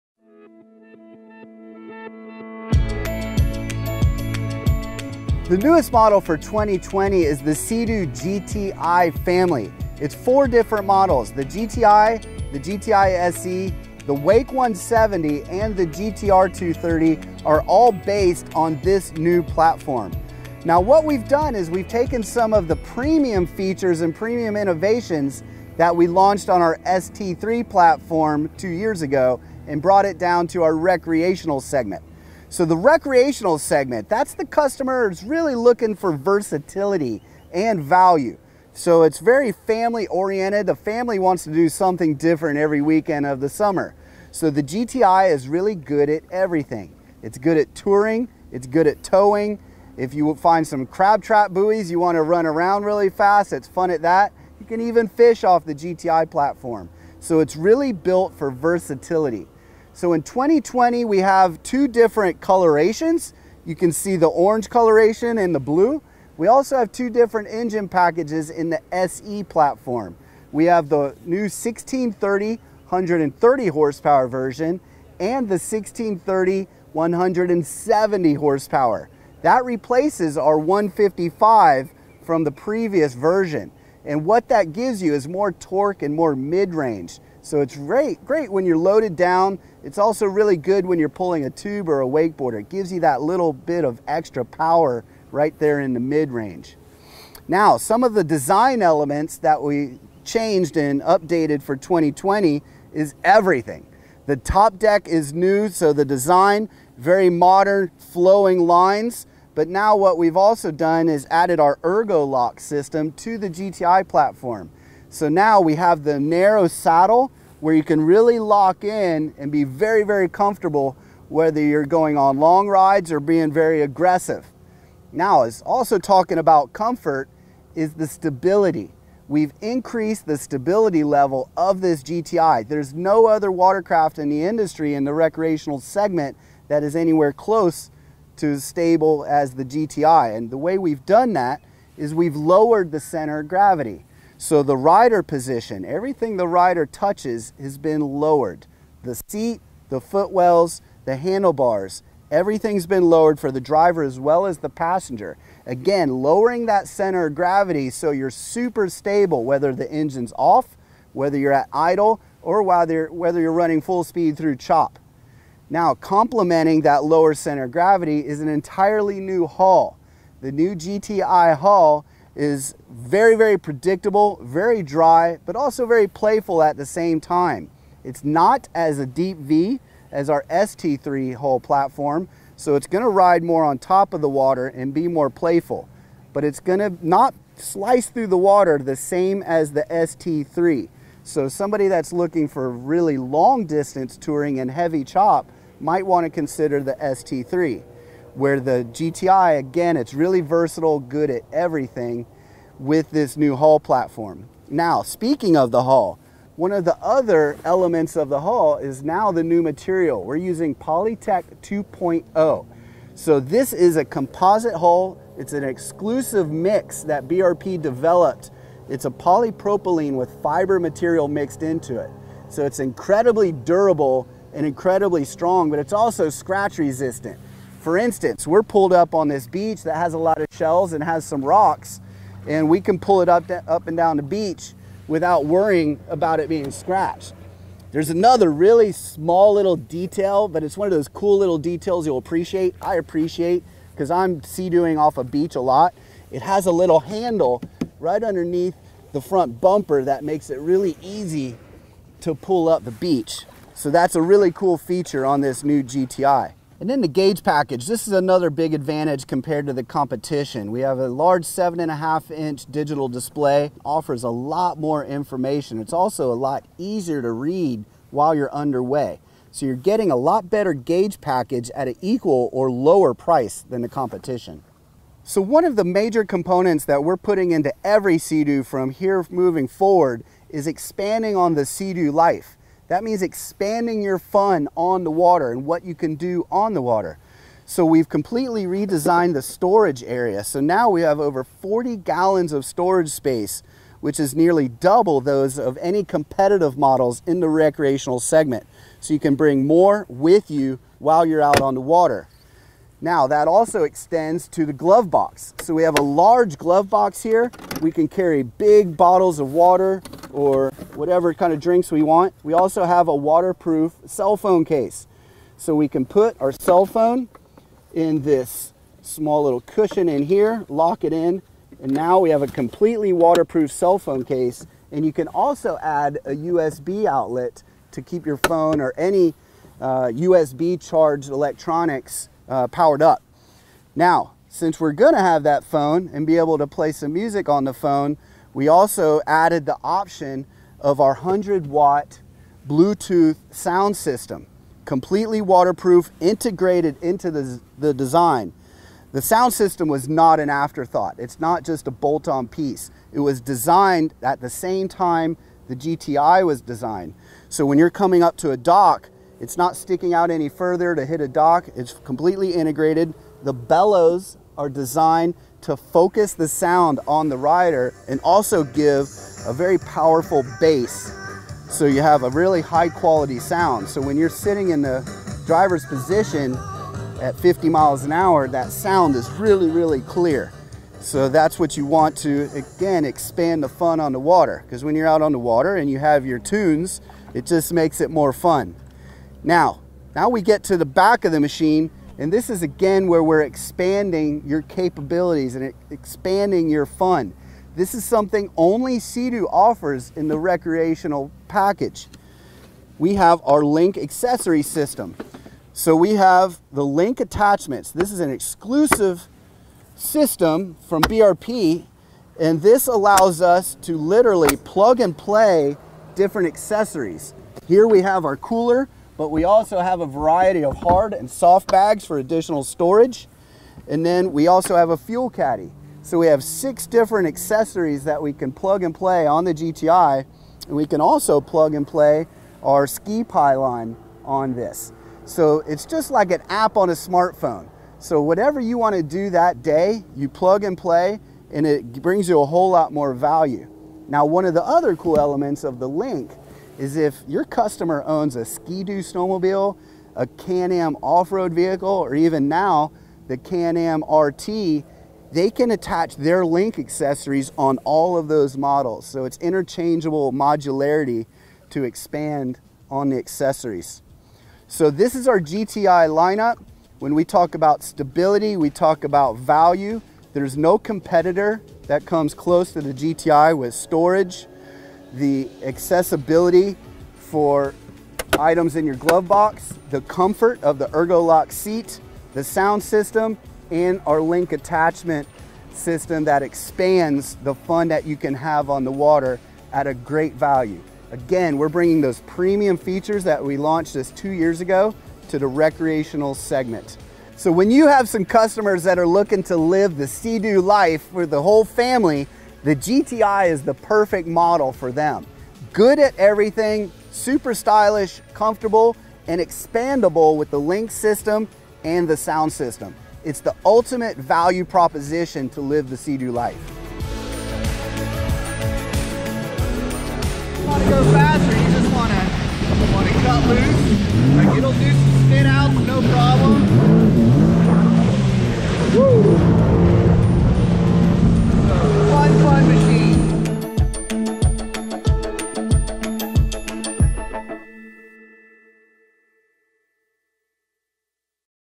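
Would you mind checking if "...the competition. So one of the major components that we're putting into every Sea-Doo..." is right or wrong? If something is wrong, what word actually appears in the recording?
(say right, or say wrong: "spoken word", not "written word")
right.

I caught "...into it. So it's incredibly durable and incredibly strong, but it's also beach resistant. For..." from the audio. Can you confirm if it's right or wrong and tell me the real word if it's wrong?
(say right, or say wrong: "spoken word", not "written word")
wrong: "scratch", not "beach".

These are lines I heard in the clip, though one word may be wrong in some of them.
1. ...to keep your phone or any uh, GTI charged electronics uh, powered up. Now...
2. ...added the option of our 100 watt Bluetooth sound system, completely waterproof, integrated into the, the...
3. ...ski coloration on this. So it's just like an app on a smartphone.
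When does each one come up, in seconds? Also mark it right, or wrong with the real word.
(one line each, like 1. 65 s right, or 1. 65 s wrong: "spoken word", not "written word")
1. 327 s wrong: "USB", not "GTI"
2. 339 s right
3. 432 s wrong: "pylon", not "coloration".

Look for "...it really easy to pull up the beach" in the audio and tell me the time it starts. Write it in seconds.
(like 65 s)
250 s.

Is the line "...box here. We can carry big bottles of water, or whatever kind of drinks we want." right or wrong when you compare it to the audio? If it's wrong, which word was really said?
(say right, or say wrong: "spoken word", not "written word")
right.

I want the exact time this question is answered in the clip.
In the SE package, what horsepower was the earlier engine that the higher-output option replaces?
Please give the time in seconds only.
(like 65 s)
80 s.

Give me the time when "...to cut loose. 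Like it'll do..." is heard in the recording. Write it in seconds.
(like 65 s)
523 s.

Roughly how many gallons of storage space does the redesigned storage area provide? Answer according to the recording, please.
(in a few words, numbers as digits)
Over 40 gallons.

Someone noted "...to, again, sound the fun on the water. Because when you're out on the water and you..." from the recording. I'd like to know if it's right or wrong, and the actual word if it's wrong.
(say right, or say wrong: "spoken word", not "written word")
wrong: "expand", not "sound".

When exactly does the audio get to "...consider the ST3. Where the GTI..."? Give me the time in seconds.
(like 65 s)
196 s.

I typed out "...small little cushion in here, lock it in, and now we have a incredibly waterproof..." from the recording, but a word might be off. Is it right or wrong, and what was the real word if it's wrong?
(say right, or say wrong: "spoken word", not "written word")
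wrong: "completely", not "incredibly".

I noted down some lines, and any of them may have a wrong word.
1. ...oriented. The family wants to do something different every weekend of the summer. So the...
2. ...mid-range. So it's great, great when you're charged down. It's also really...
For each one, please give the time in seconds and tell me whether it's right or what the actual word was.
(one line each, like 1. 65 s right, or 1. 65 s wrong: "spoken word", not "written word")
1. 40 s right
2. 86 s wrong: "loaded", not "charged".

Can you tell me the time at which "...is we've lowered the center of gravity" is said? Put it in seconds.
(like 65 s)
141 s.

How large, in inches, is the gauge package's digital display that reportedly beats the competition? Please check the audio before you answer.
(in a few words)
7.5 inches.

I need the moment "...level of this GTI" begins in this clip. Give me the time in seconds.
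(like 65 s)
131 s.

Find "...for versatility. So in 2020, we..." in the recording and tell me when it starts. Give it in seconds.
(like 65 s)
58 s.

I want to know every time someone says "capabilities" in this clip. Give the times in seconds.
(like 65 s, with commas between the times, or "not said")
394 s.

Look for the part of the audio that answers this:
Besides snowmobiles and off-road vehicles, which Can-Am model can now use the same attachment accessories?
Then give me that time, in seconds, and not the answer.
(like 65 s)
453 s.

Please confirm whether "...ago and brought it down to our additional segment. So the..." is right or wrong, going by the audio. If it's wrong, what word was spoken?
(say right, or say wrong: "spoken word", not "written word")
wrong: "recreational", not "additional".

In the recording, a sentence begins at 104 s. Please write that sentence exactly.
The top deck is new, so the design, very modern, flowing lines.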